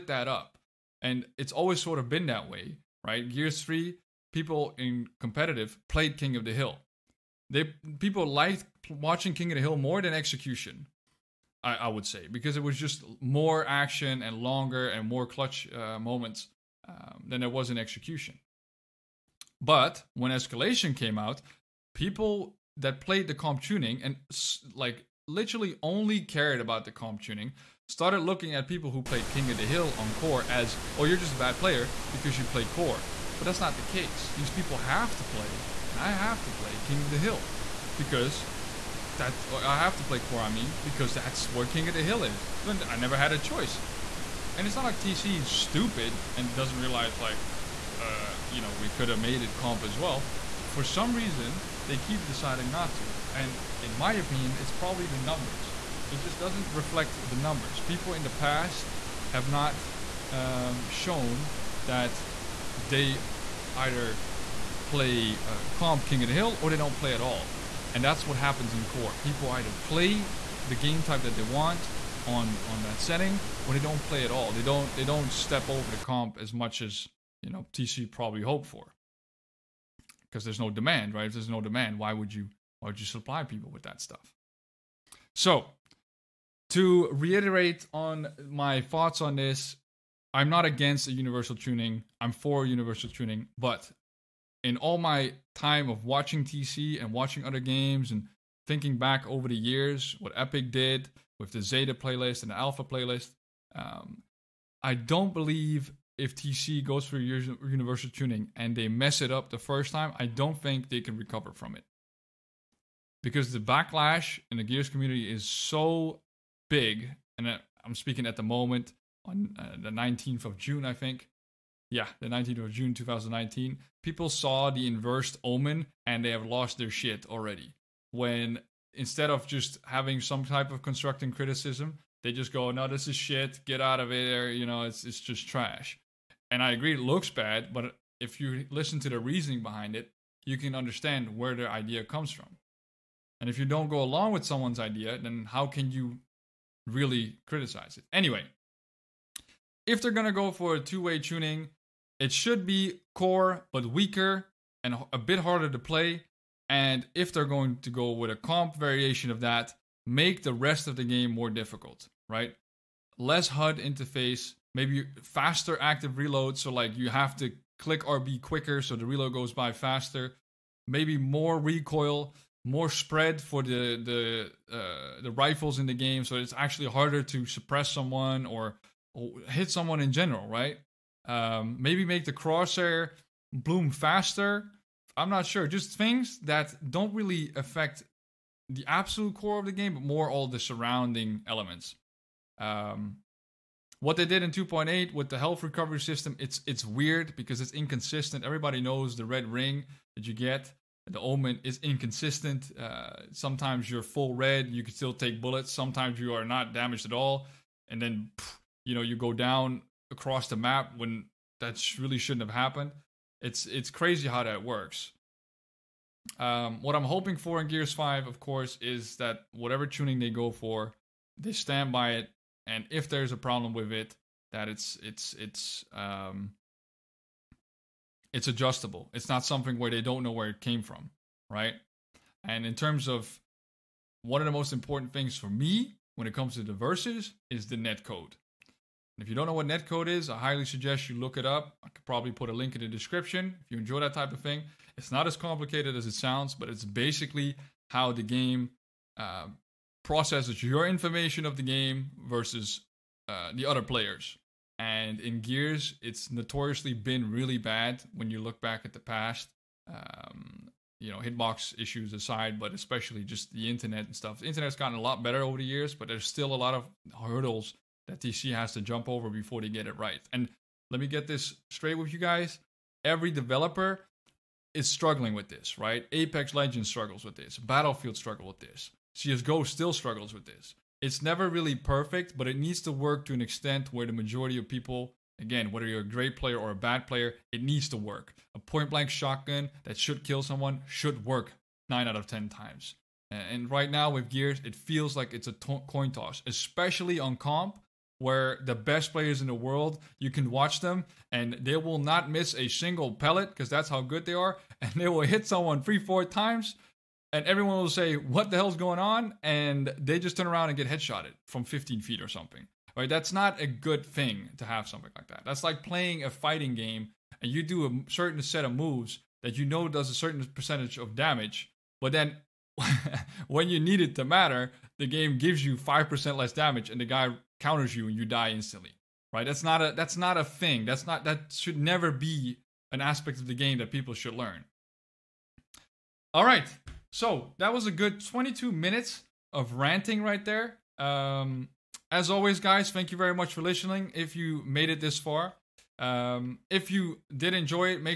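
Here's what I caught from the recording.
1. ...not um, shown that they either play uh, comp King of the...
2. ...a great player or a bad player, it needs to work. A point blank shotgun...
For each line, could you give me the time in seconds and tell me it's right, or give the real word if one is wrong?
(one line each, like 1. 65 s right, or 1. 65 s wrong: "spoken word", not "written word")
1. 59 s right
2. 286 s right.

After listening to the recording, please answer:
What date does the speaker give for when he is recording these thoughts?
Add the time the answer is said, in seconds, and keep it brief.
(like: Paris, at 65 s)
19th of June 2019, at 122 s.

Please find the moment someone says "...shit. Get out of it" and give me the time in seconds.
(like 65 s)
133 s.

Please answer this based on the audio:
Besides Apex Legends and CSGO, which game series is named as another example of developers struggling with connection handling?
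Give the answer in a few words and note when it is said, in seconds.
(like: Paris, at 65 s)
Battlefield, at 277 s.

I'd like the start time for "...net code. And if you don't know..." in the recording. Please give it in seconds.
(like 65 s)
237 s.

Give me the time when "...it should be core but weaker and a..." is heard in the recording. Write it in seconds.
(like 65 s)
152 s.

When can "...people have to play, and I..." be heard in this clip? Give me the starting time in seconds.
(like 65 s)
34 s.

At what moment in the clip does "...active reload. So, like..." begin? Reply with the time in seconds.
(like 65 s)
165 s.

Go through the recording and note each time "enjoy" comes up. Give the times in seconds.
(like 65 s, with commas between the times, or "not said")
243 s, 347 s.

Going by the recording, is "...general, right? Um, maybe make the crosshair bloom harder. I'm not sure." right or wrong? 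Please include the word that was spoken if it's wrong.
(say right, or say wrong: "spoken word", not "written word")
wrong: "faster", not "harder".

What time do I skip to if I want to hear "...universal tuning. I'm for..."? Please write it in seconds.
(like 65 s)
91 s.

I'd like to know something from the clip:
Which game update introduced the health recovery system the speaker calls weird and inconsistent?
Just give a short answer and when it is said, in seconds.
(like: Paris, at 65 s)
2.8, at 194 s.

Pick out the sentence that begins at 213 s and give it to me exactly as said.
It's it's crazy how that works.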